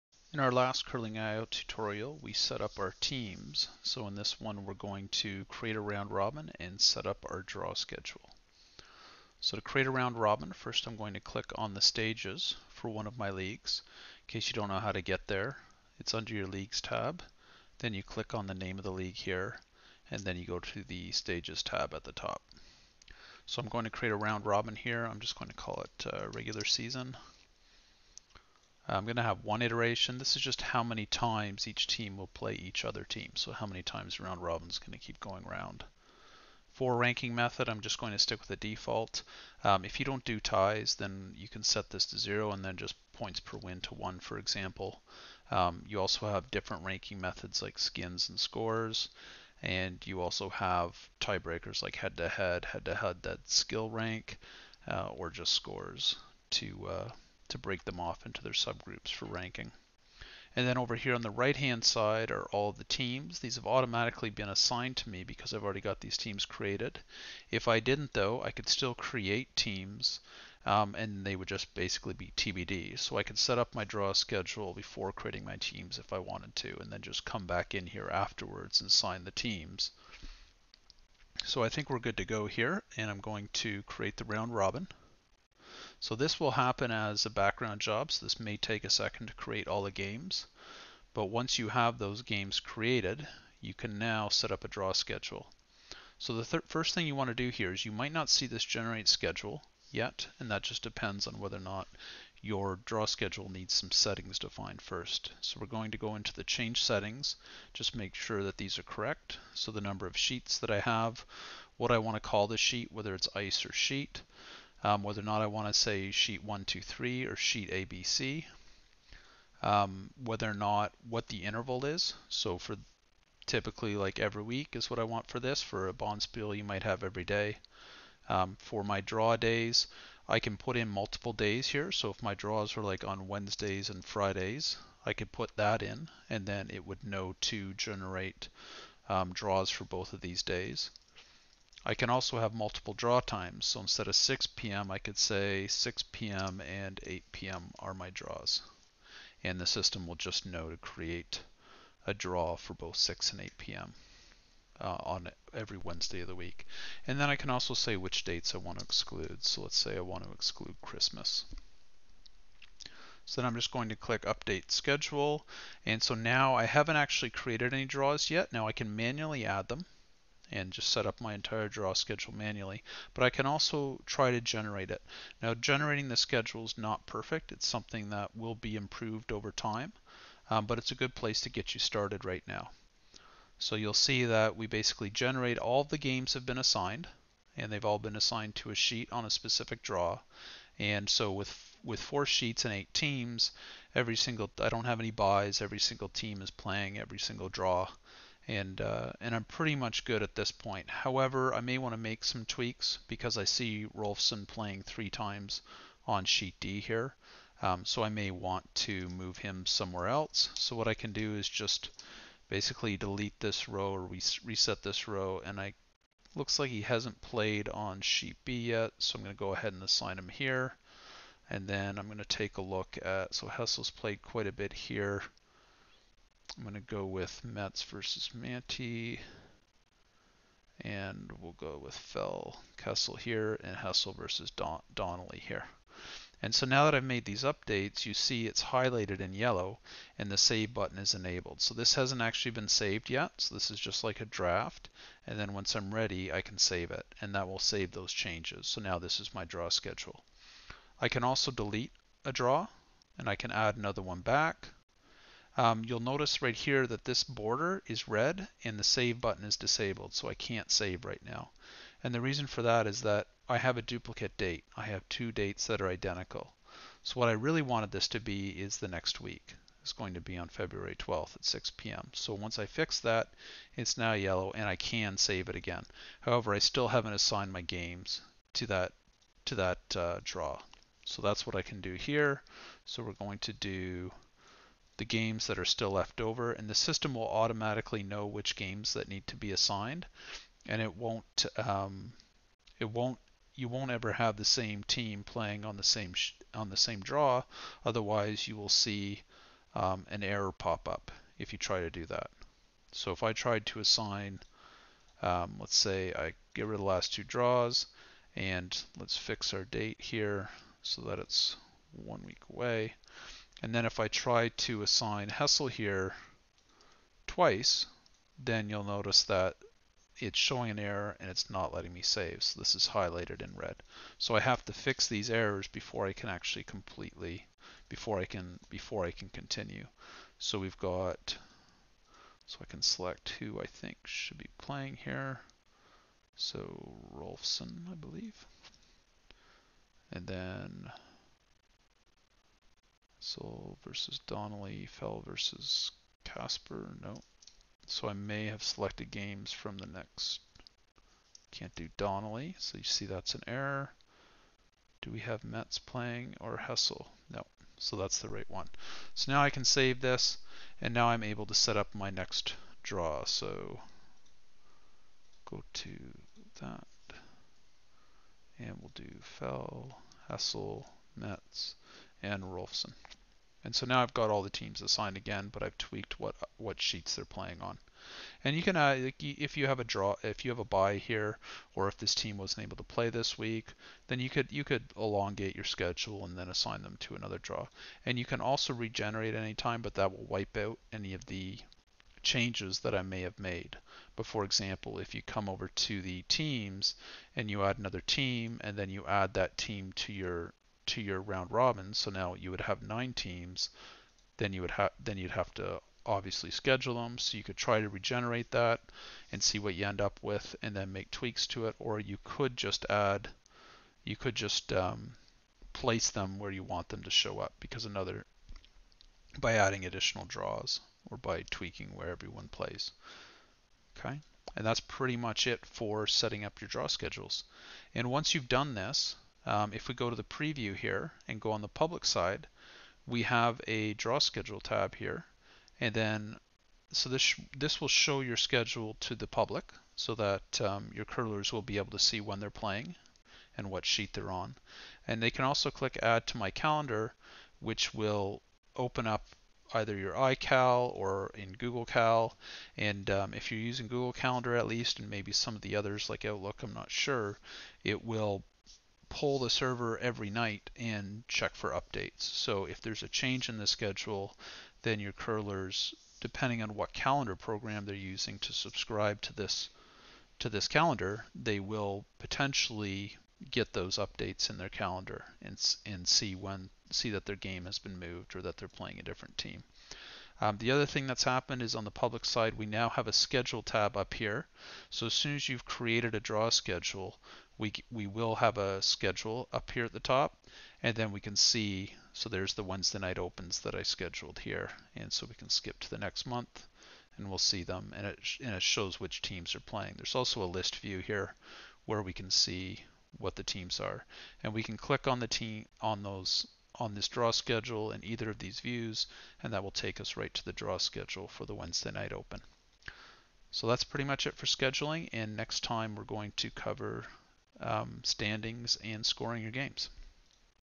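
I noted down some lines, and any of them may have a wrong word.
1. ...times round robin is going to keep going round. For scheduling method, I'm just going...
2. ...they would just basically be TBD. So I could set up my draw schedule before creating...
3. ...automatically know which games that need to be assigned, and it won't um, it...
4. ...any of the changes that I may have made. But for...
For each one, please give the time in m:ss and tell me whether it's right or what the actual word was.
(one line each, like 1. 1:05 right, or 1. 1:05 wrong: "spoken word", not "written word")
1. 0:33 wrong: "ranking", not "scheduling"
2. 1:11 right
3. 4:47 right
4. 6:30 right.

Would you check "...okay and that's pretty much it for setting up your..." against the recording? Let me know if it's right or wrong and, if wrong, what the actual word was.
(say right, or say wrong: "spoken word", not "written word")
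right.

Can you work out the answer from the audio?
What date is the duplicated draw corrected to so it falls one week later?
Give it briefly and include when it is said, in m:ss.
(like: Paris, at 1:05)
February 12, at 4:30.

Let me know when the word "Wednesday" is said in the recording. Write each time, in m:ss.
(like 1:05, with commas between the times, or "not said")
2:13, 2:35, 8:12, 8:31.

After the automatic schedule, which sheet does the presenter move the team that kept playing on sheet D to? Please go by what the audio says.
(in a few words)
Sheet B.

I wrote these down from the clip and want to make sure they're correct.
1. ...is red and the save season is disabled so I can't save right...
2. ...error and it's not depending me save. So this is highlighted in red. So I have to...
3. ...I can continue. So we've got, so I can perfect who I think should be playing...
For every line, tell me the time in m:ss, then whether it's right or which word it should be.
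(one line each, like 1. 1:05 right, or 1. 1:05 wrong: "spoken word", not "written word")
1. 4:17 wrong: "button", not "season"
2. 5:20 wrong: "letting", not "depending"
3. 5:29 wrong: "select", not "perfect".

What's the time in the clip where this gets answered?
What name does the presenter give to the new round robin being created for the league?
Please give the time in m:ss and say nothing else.
0:26.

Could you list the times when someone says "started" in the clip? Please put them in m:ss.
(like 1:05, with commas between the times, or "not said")
3:01.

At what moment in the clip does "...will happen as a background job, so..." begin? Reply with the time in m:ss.
1:26.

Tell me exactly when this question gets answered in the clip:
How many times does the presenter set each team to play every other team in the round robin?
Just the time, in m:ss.
0:29.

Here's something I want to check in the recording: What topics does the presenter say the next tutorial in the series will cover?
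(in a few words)
Standings and scoring.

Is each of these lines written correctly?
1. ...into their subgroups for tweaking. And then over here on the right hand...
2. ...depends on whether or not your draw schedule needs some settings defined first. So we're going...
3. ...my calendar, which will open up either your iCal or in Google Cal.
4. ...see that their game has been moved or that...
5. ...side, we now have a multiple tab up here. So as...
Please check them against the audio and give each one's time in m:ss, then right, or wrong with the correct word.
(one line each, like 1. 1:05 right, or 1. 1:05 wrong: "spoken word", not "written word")
1. 0:58 wrong: "ranking", not "tweaking"
2. 1:40 right
3. 7:26 right
4. 7:56 right
5. 8:02 wrong: "schedule", not "multiple".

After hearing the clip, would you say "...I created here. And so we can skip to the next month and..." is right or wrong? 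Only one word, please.
wrong.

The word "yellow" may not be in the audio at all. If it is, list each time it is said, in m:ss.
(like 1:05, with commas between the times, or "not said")
3:59, 4:34.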